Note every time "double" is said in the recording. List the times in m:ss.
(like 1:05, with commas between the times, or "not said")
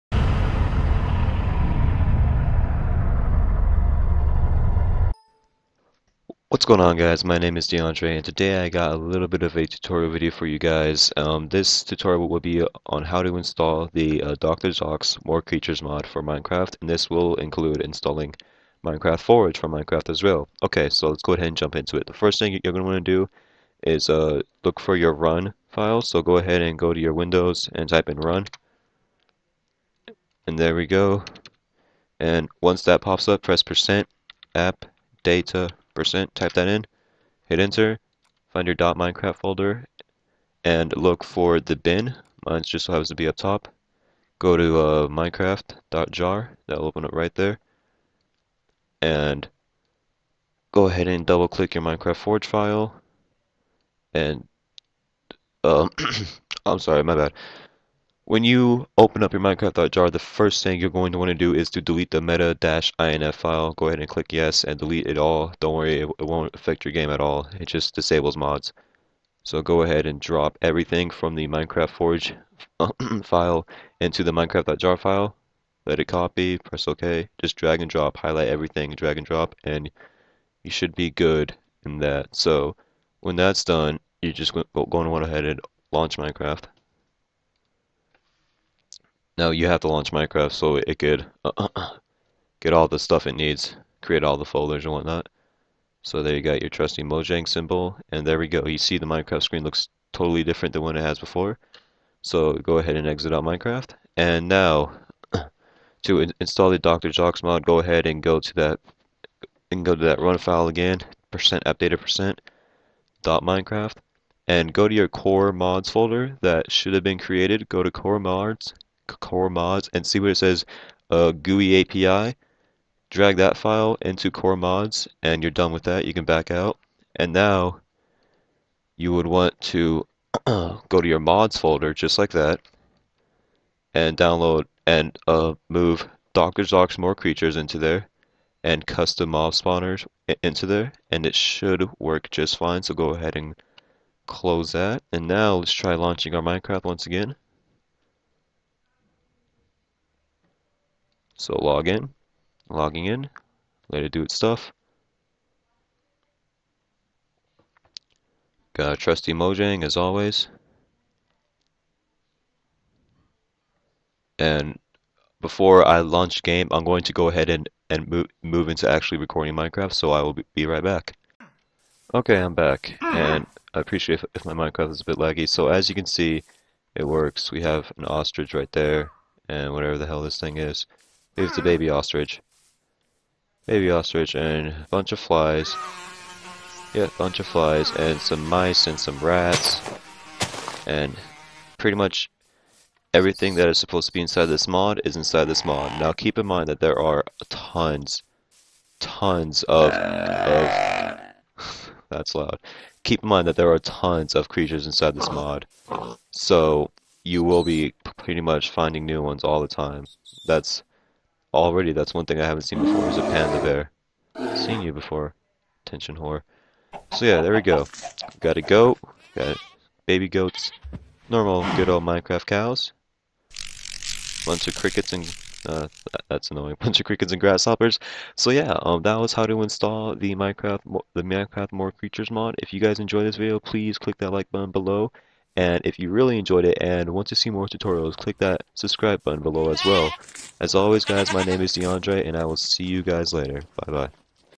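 0:51.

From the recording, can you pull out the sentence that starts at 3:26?
So you will be pretty much finding new ones all the time.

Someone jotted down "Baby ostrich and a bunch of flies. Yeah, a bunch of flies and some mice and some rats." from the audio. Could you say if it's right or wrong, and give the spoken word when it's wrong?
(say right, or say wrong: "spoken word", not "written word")
right.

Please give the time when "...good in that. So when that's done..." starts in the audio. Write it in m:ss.
1:21.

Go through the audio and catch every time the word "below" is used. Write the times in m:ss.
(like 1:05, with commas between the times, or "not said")
3:54, 3:59.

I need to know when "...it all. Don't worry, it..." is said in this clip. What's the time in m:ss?
1:05.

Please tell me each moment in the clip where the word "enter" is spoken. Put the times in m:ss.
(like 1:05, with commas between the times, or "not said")
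0:37.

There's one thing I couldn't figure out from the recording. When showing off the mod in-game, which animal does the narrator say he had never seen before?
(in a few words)
Panda bear.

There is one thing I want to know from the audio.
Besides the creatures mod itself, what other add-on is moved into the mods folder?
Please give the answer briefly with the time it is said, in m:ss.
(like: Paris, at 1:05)
Custom mob spawners, at 2:18.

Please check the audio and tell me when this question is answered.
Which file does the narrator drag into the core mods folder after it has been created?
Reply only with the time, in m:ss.
2:01.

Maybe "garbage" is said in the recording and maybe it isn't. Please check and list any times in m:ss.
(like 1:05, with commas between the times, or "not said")
not said.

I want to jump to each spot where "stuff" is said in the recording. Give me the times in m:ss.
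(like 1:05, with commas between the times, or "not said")
1:32, 2:34.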